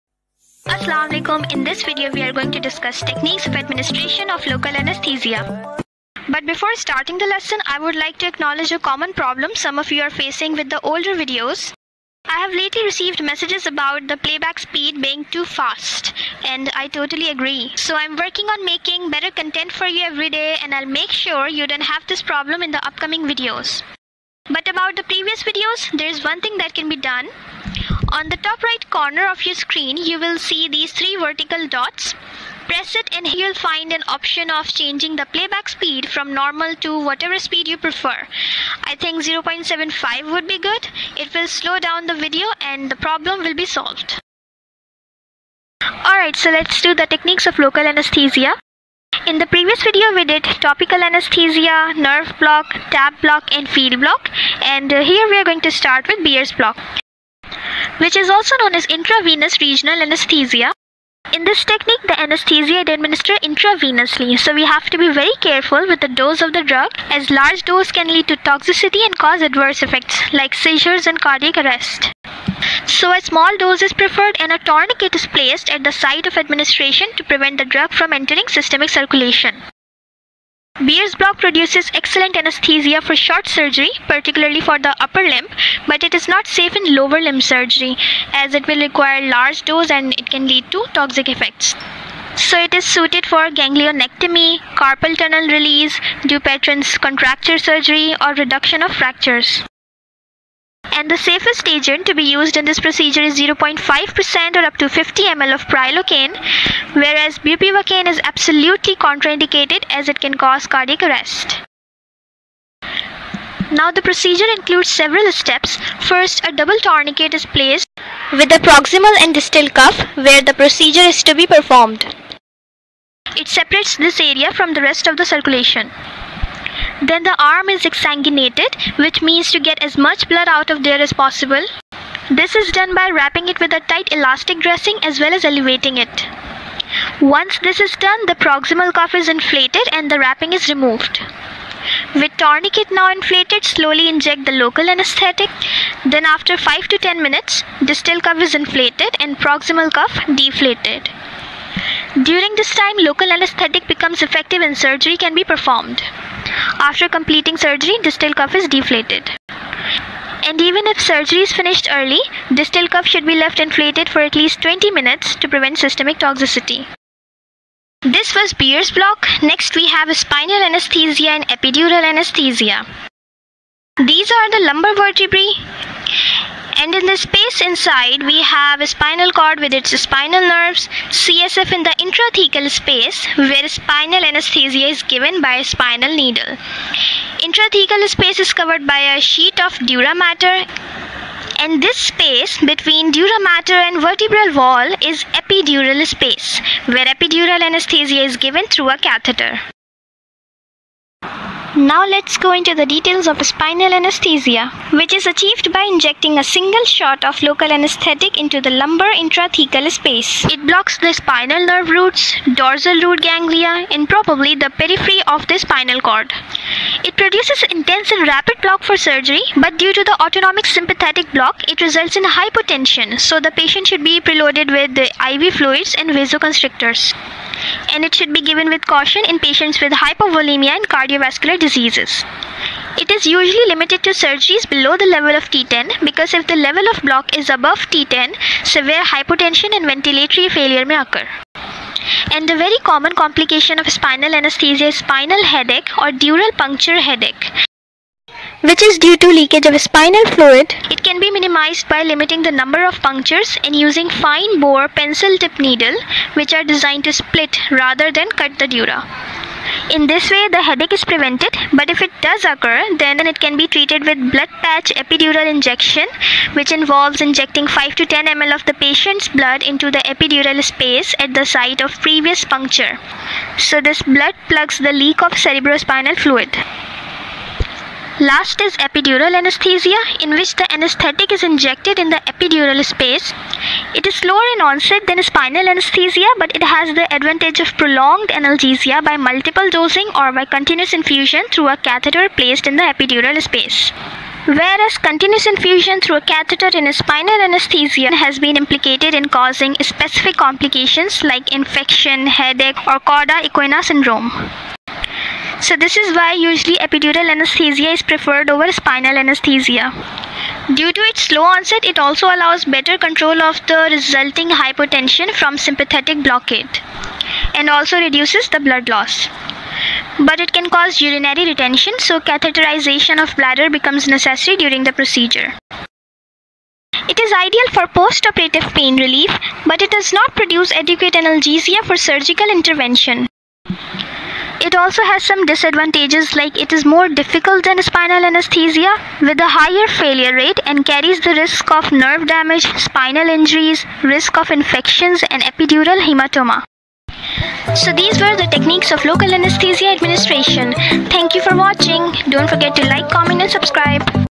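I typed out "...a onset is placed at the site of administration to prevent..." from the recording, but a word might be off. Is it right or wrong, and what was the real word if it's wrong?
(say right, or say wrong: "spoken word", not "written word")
wrong: "tourniquet", not "onset".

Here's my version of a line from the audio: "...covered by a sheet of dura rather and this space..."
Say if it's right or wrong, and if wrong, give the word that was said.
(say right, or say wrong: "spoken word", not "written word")
wrong: "mater", not "rather".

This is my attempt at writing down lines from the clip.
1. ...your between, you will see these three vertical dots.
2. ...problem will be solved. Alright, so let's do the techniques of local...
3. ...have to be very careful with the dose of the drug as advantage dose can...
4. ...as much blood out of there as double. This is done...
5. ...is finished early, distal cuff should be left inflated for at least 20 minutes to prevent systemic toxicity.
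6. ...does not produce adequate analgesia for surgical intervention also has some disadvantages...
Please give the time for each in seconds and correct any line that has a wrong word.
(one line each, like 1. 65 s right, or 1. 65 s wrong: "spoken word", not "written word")
1. 29 s wrong: "screen", not "between"
2. 42 s right
3. 64 s wrong: "large", not "advantage"
4. 129 s wrong: "possible", not "double"
5. 161 s right
6. 329 s right.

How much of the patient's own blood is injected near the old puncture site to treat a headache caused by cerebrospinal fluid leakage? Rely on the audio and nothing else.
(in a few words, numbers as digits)
5 to 10 ml.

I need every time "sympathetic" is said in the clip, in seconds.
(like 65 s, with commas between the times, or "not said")
220 s, 315 s.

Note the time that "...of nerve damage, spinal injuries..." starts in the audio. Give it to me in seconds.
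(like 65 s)
341 s.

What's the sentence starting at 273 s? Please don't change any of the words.
So, this blood plugs the leak of cerebrospinal fluid.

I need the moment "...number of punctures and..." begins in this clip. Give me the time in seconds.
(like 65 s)
252 s.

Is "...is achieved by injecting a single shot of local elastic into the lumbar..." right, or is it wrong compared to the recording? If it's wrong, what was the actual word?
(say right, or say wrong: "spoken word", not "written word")
wrong: "anesthetic", not "elastic".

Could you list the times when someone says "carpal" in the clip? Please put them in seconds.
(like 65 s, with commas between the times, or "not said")
94 s.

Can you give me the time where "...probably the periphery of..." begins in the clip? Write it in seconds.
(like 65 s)
214 s.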